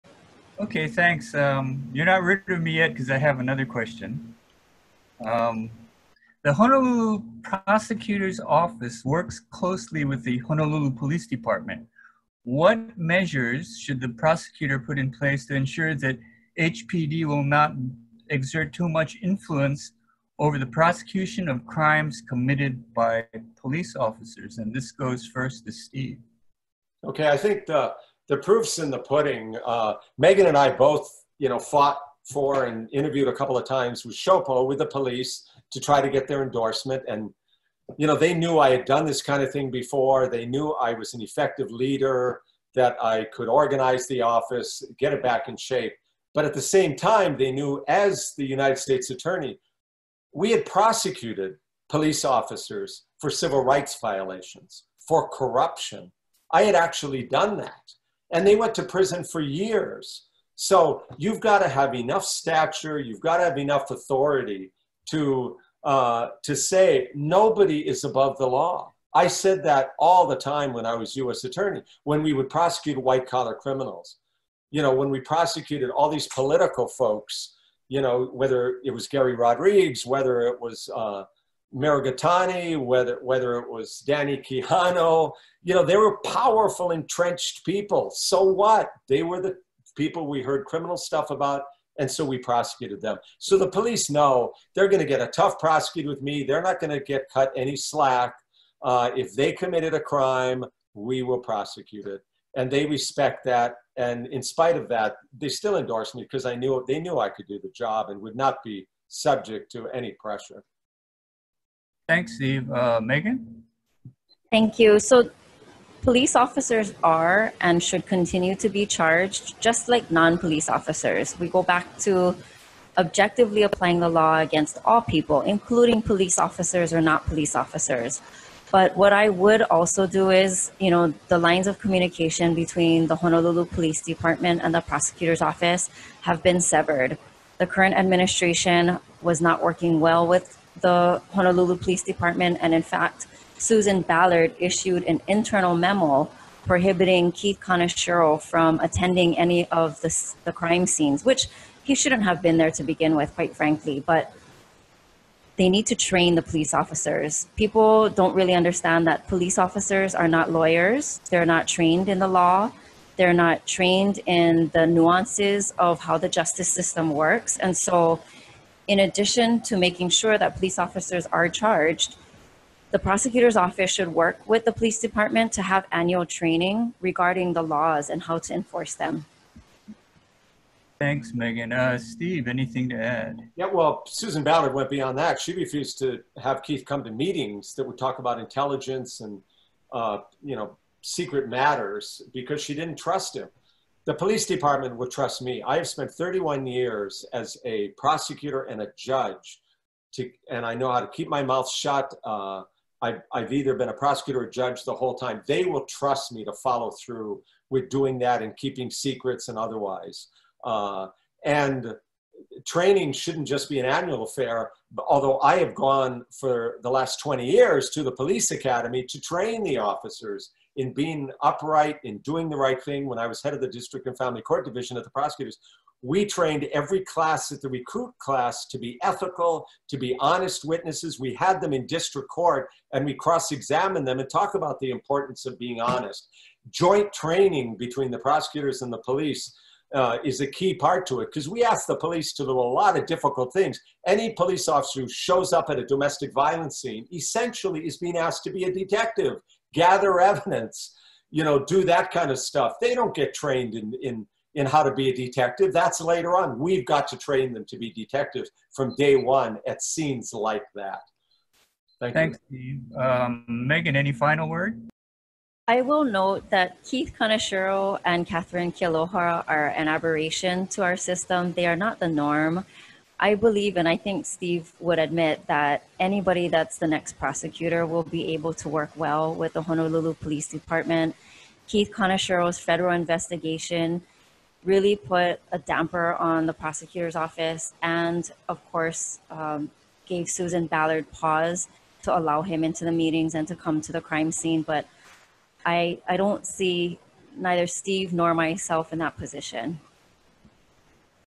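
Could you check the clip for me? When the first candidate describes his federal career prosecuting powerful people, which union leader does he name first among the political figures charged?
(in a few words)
Gary Rodrigues.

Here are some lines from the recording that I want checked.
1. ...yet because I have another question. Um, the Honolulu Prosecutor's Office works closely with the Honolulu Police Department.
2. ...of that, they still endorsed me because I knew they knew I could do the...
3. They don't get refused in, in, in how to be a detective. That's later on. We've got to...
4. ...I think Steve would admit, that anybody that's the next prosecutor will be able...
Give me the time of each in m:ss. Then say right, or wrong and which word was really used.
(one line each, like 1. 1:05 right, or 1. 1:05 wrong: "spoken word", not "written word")
1. 0:02 right
2. 1:44 right
3. 4:12 wrong: "trained", not "refused"
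4. 4:33 right.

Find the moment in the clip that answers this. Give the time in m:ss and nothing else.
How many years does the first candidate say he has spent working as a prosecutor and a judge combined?
3:16.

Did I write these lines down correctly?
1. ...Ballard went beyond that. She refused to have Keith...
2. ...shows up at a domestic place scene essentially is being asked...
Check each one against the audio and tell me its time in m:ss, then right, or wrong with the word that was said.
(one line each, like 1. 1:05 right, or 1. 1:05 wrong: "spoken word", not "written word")
1. 3:04 right
2. 4:05 wrong: "violence", not "place".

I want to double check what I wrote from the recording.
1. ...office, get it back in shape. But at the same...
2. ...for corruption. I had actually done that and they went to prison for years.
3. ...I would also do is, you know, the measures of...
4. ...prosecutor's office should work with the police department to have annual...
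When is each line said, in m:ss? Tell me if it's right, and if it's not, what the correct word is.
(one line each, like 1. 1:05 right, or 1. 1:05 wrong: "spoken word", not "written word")
1. 0:44 right
2. 0:55 right
3. 2:09 wrong: "lines", not "measures"
4. 2:52 right.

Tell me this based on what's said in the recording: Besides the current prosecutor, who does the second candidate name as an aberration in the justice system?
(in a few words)
Katherine Kealoha.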